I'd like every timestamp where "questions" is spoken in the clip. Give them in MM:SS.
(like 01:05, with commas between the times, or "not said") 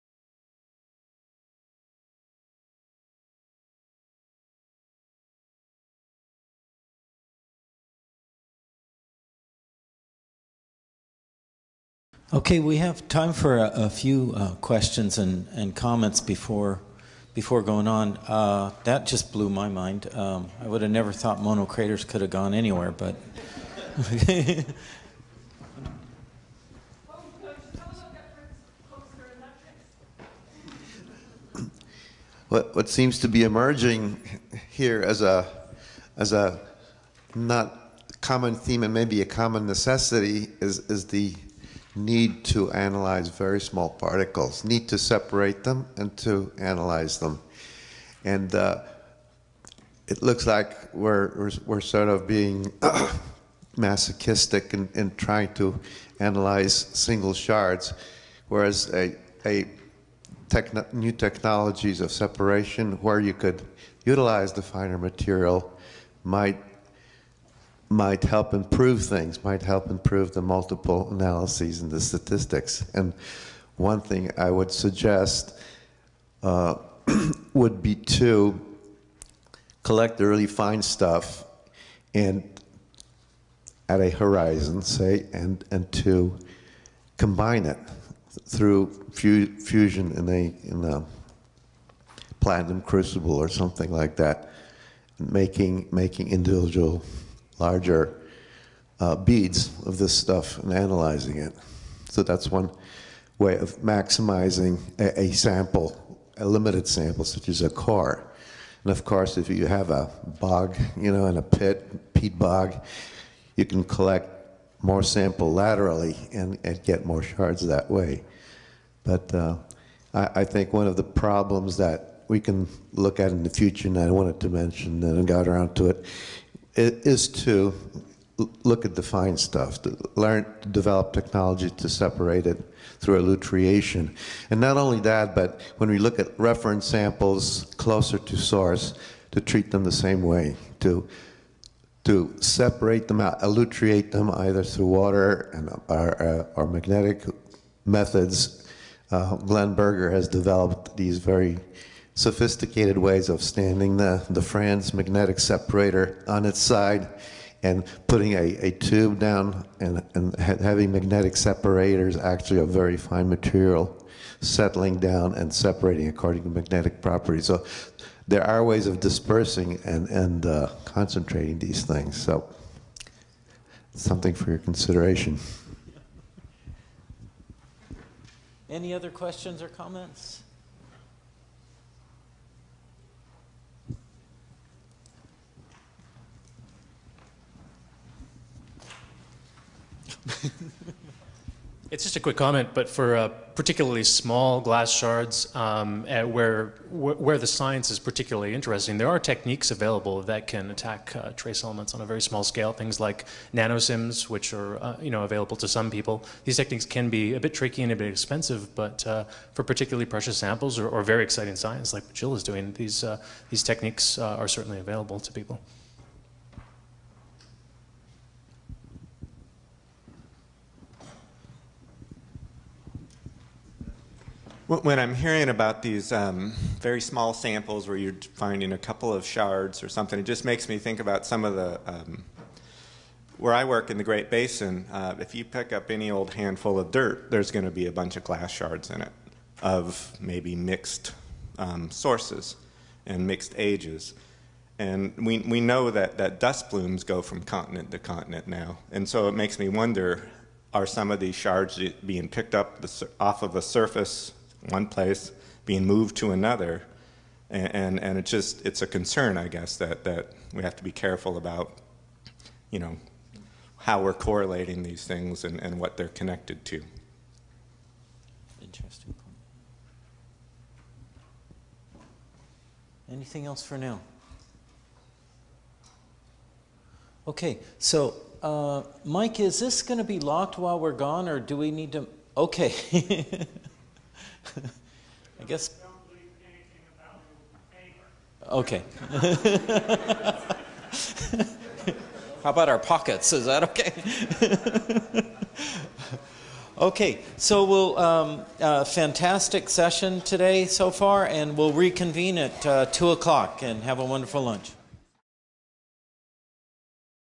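00:14, 02:59.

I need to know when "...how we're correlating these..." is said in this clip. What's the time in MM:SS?
04:23.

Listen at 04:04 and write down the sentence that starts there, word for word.
And we, we know that, that dust blooms go from continent to continent now.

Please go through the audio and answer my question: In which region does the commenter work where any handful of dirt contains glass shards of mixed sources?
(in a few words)
Great Basin.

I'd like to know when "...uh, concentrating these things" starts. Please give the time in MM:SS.
02:50.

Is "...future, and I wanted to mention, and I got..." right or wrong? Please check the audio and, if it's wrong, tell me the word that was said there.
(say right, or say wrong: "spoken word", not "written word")
right.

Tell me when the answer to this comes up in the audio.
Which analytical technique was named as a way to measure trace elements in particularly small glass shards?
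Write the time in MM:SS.
03:23.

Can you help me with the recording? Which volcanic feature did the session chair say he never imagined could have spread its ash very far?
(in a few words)
Mono Craters.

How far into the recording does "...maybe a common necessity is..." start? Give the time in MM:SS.
00:38.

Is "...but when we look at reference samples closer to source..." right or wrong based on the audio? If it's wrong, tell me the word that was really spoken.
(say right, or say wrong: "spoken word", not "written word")
right.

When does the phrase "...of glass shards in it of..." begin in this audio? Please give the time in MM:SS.
03:58.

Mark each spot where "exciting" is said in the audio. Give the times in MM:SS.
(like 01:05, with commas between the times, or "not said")
03:31.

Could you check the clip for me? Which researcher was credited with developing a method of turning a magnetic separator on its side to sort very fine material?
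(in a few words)
Glenn Berger.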